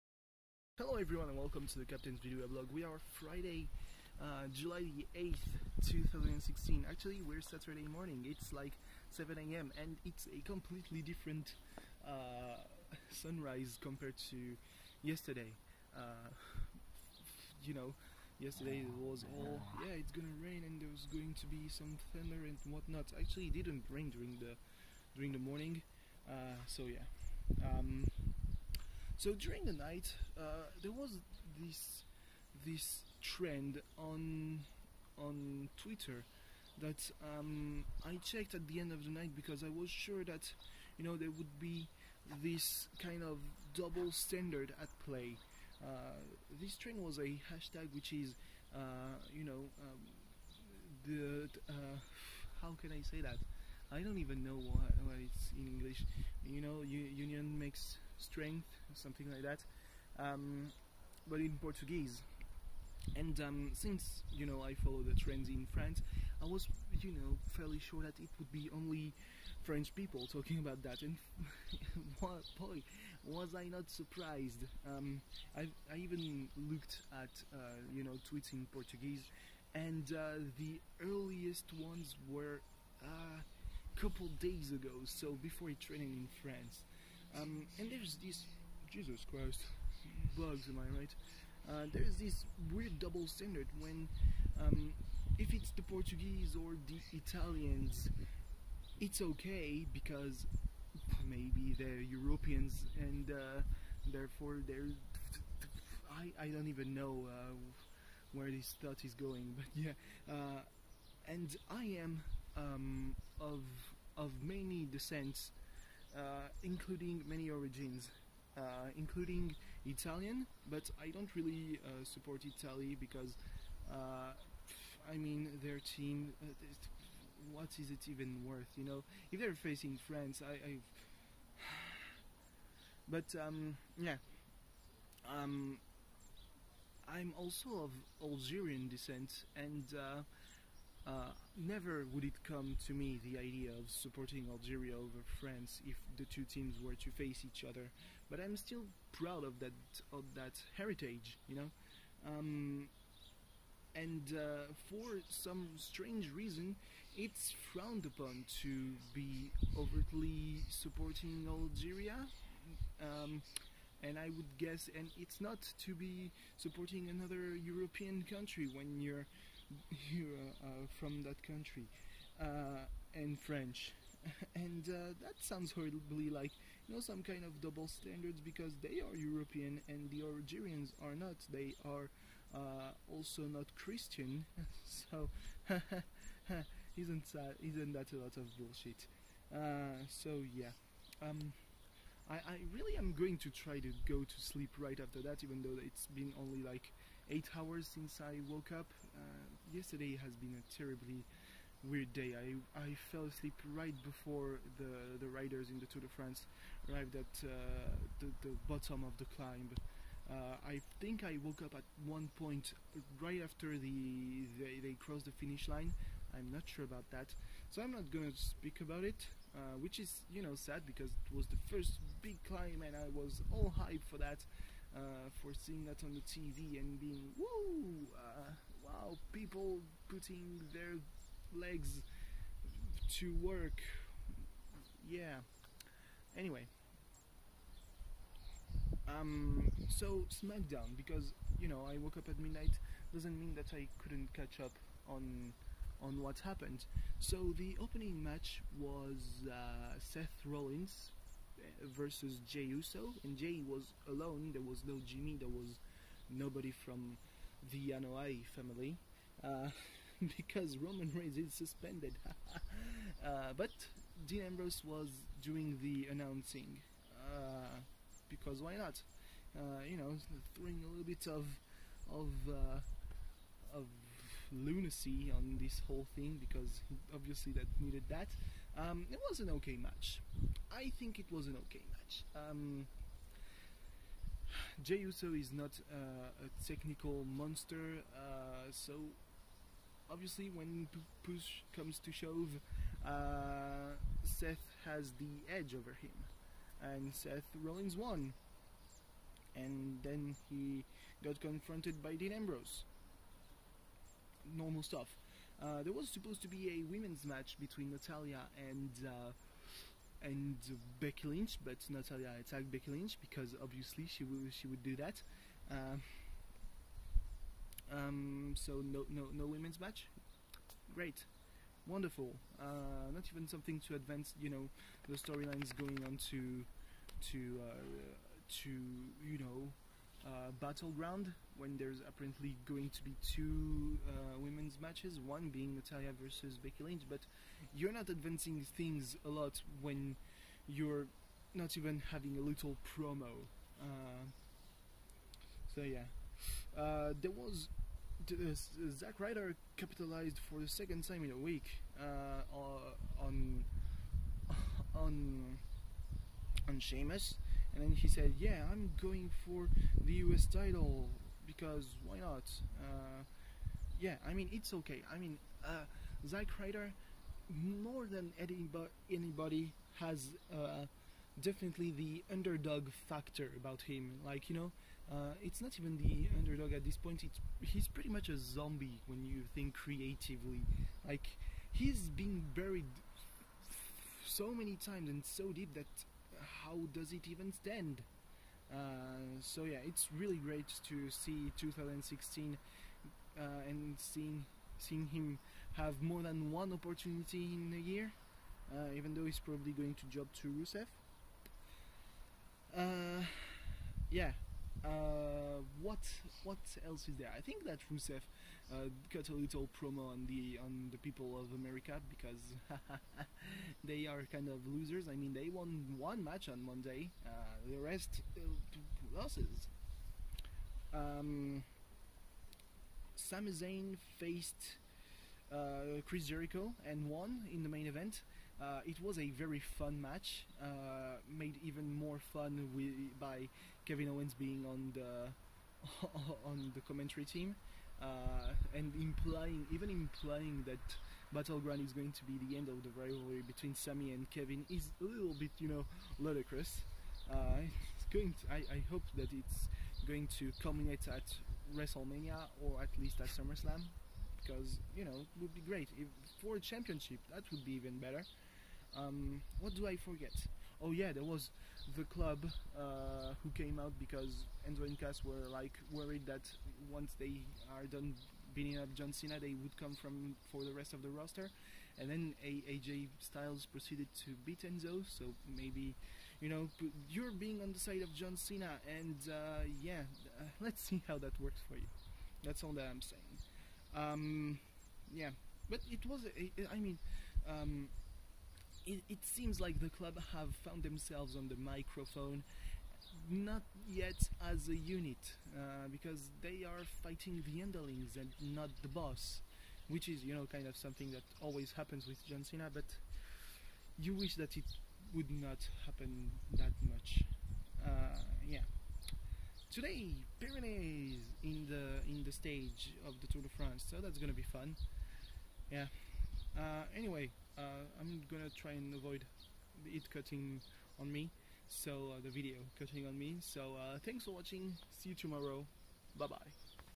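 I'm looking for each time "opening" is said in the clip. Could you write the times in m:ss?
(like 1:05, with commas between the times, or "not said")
4:07.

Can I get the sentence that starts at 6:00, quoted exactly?
title because why not?" Uh, yeah, I mean it's okay.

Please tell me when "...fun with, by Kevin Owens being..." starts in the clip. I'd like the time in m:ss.
7:12.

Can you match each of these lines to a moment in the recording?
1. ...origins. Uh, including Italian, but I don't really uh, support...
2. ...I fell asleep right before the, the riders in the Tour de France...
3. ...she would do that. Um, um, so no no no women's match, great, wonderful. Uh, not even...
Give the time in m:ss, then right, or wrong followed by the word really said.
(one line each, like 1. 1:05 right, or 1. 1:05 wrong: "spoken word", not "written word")
1. 1:57 right
2. 3:22 right
3. 5:14 right.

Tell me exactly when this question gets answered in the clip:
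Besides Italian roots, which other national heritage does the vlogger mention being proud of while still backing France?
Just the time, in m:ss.
2:18.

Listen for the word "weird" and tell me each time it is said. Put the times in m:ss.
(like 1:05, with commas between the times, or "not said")
1:32, 3:21.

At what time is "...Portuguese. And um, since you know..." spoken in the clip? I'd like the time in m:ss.
1:01.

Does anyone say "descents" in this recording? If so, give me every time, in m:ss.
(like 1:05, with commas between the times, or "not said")
1:54, 2:18.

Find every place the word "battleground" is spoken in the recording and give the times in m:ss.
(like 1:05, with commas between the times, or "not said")
5:30, 7:21.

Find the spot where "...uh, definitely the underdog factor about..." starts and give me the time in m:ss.
6:10.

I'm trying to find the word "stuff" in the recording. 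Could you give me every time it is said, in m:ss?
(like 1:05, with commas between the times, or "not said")
5:04.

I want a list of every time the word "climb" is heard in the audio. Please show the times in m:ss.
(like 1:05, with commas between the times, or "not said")
3:29, 3:42.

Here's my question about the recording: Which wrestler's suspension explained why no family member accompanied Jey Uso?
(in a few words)
Roman Reigns.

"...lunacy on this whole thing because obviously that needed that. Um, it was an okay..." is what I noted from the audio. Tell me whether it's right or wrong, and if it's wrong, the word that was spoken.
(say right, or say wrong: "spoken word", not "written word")
right.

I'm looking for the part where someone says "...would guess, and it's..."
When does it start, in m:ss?
2:44.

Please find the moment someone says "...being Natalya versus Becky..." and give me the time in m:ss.
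5:35.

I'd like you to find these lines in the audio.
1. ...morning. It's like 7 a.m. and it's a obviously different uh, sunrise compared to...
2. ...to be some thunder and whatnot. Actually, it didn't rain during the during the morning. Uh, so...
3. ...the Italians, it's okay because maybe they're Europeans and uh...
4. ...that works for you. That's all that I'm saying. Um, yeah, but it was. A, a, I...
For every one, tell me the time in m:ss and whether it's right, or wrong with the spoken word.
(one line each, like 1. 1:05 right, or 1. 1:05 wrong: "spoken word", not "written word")
1. 0:07 wrong: "completely", not "obviously"
2. 0:21 right
3. 1:36 right
4. 8:01 right.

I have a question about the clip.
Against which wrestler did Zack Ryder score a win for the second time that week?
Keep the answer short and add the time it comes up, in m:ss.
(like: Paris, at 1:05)
Sheamus, at 5:56.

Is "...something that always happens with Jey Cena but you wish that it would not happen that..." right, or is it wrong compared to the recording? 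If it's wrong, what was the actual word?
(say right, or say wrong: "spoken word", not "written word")
wrong: "John", not "Jey".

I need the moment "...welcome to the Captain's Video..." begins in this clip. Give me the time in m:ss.
0:01.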